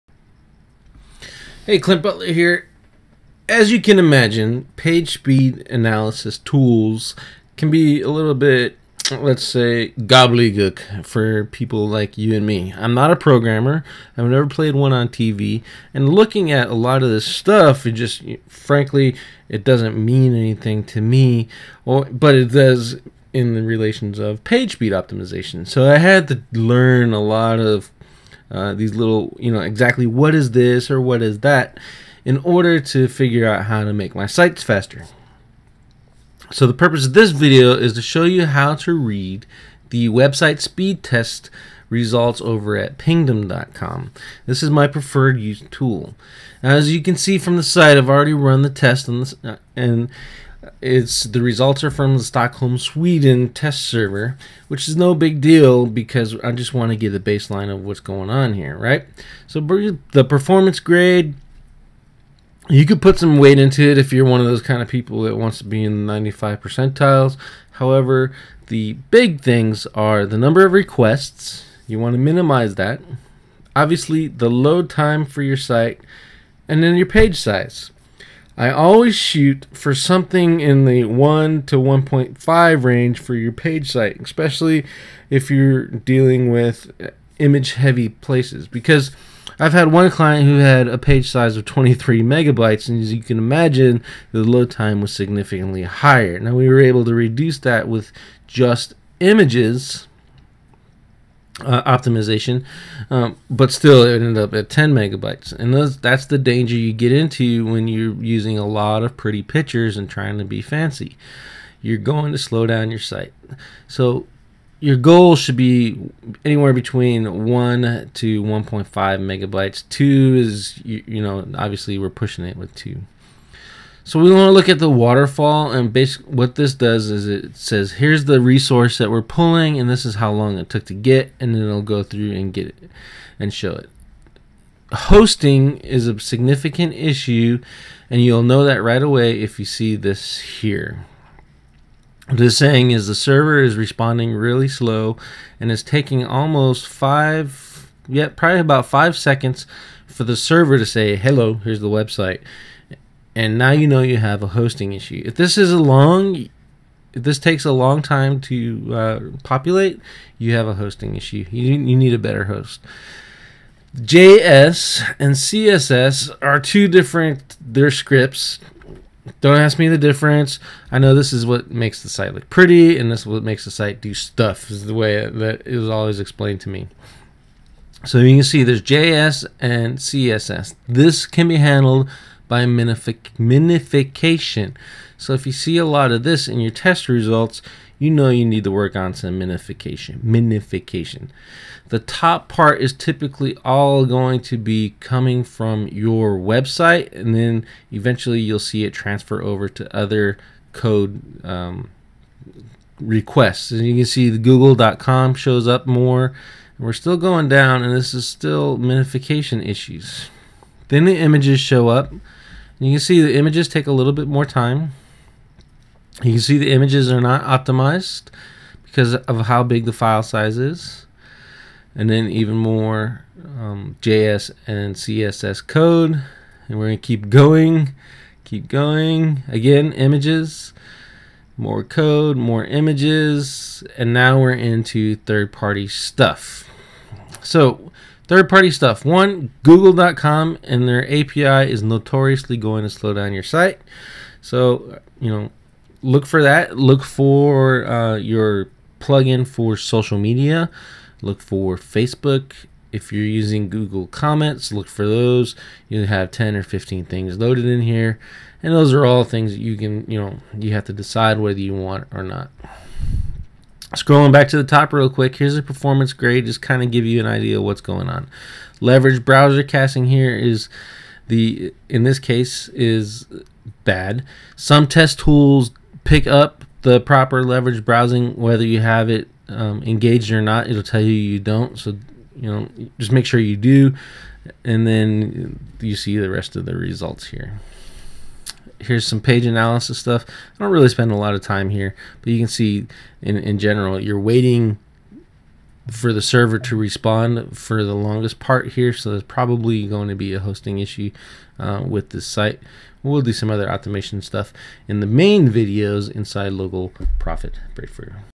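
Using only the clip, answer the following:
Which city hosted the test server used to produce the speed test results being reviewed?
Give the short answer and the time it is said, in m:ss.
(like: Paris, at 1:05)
Stockholm, at 0:52.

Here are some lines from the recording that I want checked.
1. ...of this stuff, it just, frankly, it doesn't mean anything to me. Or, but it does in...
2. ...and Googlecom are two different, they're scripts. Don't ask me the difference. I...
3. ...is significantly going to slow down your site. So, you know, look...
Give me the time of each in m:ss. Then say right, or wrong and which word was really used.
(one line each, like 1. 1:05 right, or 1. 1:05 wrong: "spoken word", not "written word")
1. 0:17 right
2. 2:45 wrong: "CSS", not "Googlecom"
3. 4:01 wrong: "notoriously", not "significantly".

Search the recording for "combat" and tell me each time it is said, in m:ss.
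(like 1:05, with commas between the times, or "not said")
not said.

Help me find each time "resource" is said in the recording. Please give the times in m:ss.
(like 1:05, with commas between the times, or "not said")
2:08.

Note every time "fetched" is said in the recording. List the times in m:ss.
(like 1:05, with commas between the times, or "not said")
not said.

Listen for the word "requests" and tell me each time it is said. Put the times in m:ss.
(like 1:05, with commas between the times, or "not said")
1:10, 3:22.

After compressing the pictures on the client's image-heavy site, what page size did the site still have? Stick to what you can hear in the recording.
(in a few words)
10 megabytes.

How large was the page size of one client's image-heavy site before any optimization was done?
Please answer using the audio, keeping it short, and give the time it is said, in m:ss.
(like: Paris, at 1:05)
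23 megabytes, at 1:31.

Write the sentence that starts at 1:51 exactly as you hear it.
You're going to slow down your site.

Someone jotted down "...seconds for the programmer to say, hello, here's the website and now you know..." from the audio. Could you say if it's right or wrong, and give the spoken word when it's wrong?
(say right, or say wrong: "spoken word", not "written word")
wrong: "server", not "programmer".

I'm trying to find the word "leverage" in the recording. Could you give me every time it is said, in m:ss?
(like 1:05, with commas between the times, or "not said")
4:28, 4:37.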